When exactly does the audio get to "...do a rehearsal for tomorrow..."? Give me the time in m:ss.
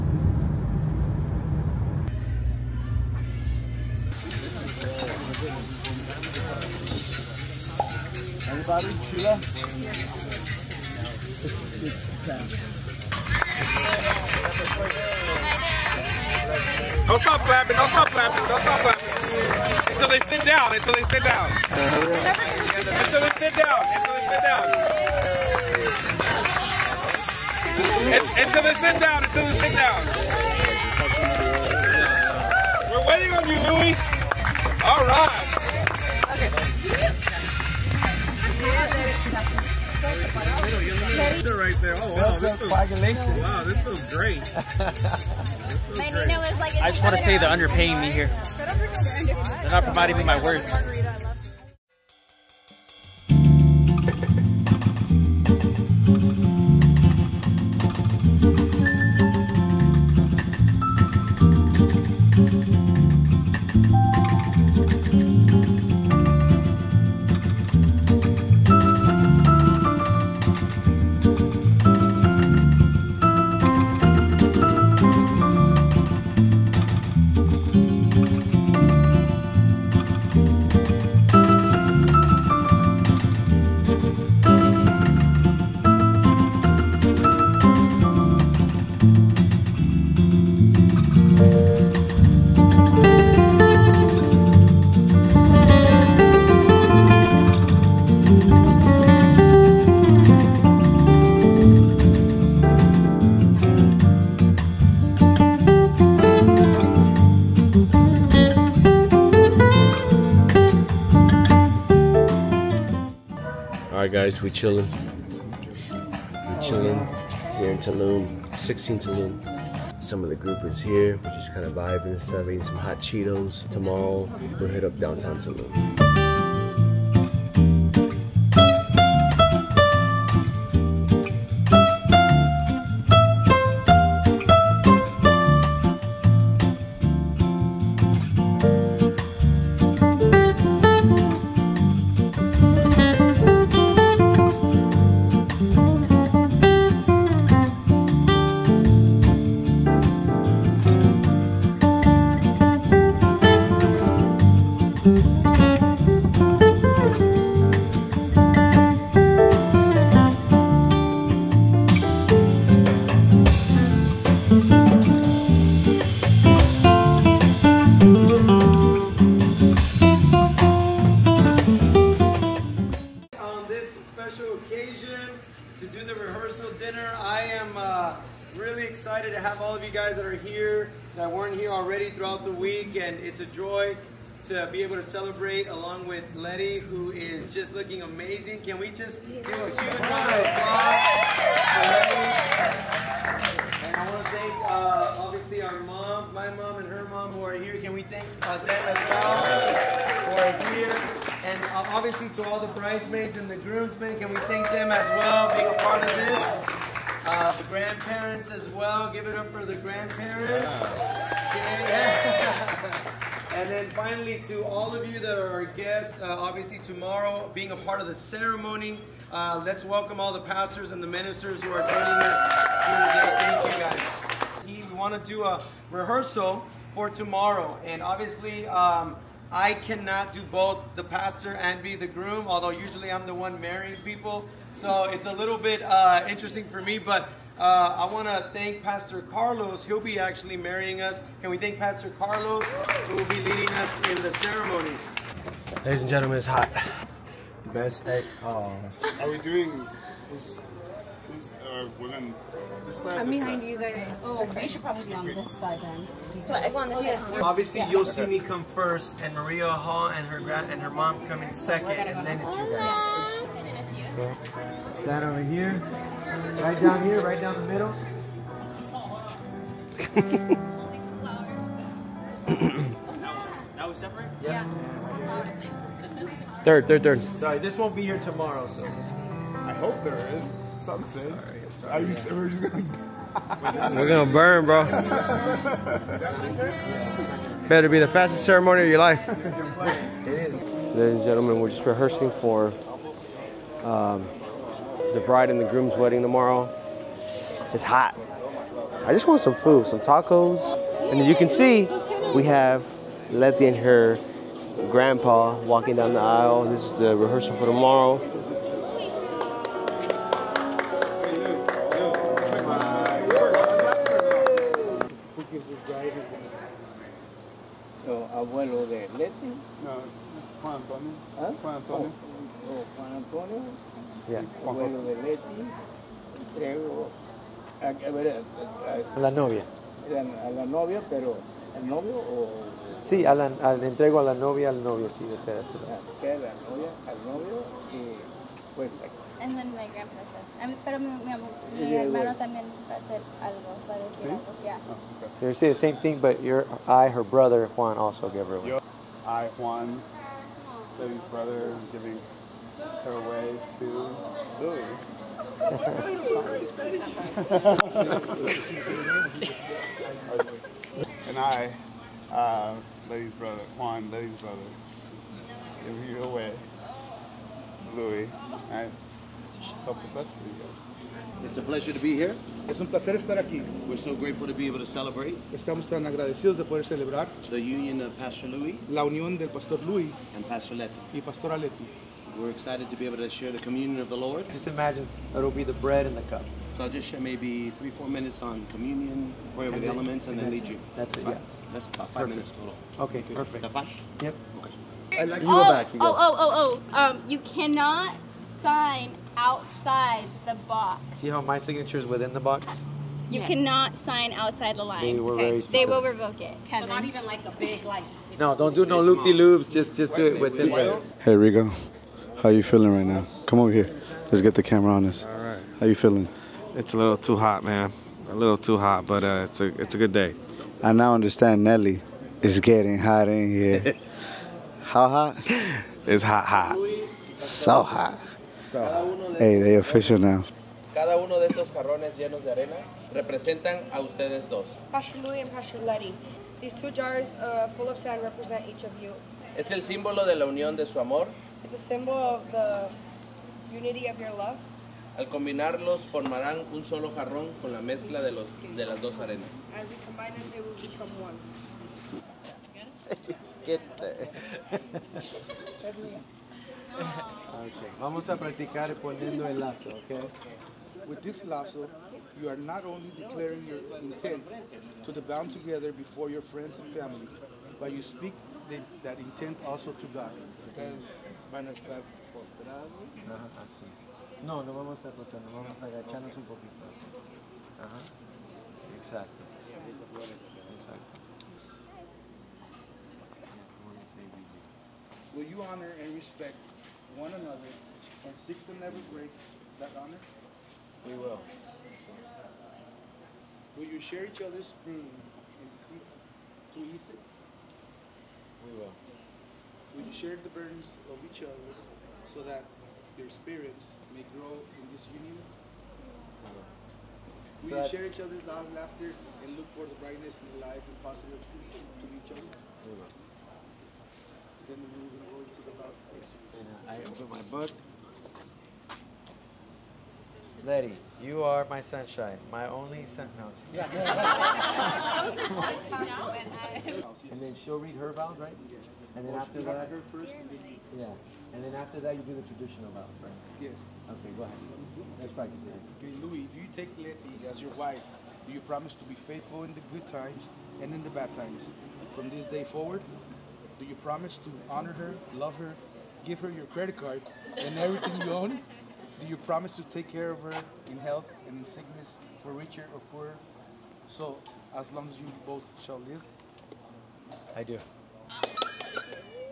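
3:45.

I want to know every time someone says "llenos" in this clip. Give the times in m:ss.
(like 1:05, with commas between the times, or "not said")
7:12.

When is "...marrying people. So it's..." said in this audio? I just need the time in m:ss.
3:53.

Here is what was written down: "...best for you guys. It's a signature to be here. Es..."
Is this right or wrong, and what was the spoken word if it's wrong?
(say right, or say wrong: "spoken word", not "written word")
wrong: "pleasure", not "signature".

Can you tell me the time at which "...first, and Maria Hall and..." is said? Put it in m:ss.
4:18.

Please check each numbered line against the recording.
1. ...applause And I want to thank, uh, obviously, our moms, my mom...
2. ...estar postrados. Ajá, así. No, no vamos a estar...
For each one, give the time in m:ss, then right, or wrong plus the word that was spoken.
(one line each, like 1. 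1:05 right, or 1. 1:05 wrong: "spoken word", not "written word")
1. 3:10 right
2. 7:51 right.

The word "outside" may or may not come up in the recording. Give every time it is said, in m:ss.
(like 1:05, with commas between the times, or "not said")
6:39, 6:44.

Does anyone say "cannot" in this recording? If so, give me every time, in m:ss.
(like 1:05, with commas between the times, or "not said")
3:49, 6:37, 6:43.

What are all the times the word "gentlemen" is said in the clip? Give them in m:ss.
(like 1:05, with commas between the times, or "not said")
4:06, 4:51.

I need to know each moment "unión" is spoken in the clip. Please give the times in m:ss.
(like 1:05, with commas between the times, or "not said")
6:19, 7:20.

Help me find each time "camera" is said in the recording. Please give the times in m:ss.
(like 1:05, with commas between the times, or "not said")
6:54.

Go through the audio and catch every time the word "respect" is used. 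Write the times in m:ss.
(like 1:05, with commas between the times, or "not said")
8:06.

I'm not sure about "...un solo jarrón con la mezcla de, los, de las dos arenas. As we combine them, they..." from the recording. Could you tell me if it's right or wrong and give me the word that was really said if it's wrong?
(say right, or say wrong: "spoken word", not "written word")
right.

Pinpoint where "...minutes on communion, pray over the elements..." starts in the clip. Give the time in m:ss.
6:28.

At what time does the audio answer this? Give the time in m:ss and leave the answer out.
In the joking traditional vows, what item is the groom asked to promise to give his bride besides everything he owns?
9:06.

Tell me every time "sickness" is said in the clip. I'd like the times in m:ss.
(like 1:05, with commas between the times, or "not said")
9:11.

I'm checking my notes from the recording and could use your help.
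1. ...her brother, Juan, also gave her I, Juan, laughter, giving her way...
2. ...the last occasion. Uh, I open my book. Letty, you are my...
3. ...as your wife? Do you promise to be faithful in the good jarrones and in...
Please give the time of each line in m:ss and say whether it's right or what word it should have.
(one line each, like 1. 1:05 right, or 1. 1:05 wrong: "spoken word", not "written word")
1. 5:47 wrong: "brother", not "laughter"
2. 8:35 wrong: "question", not "occasion"
3. 8:57 wrong: "times", not "jarrones".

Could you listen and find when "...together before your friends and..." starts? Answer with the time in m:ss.
7:45.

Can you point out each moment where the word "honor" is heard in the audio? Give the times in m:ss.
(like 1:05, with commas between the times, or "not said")
8:05, 8:10, 9:04.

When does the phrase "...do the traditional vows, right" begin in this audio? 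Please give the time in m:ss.
8:52.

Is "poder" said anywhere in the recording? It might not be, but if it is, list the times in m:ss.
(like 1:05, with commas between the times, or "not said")
6:16.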